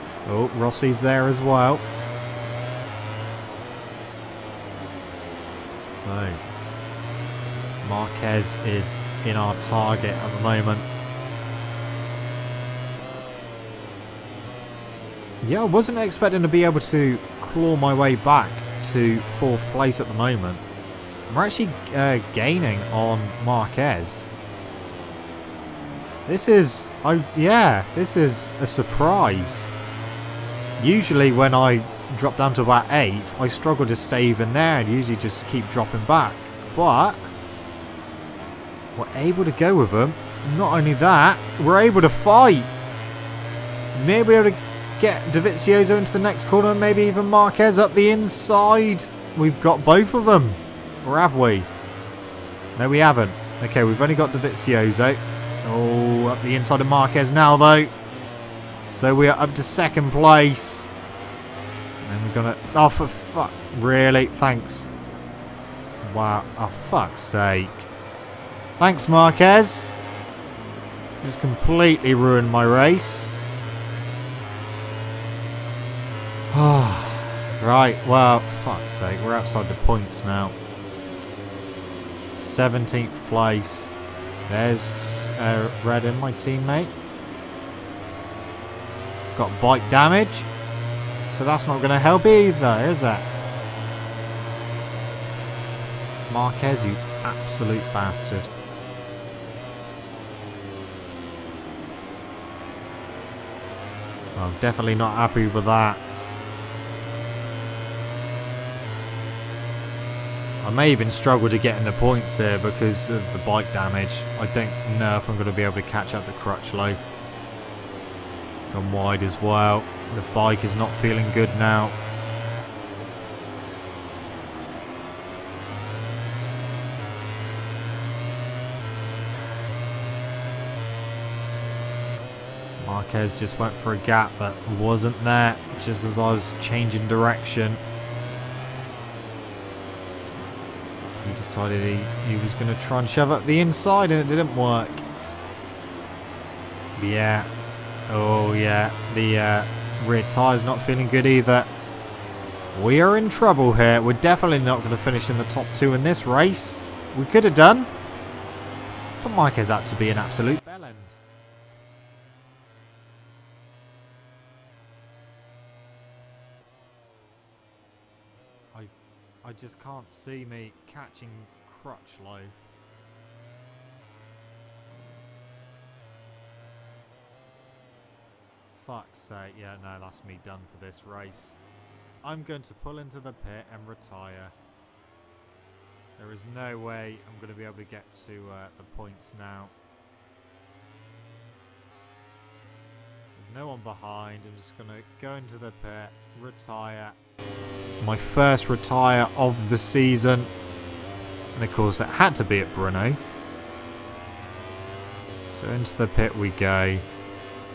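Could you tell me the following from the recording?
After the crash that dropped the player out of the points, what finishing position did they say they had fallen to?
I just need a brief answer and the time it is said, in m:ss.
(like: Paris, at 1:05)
17th, at 1:22.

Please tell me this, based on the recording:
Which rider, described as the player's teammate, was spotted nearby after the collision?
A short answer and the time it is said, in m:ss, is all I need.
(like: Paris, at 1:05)
Redding, at 1:25.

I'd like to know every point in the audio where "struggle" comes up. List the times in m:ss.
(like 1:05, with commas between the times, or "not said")
0:33, 1:51.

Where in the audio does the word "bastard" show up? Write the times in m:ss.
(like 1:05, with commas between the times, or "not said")
1:37.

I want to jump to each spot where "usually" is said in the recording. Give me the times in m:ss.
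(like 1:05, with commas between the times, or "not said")
0:30, 0:34.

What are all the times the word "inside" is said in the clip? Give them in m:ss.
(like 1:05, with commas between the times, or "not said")
0:48, 0:56, 2:23.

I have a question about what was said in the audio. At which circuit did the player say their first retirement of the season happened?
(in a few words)
Bruno.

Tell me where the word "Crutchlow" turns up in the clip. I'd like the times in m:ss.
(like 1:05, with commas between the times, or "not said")
1:56, 2:51.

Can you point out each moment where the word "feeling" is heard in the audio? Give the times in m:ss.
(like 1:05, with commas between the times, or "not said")
2:00, 2:30.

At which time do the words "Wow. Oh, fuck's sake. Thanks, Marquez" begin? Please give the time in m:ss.
1:06.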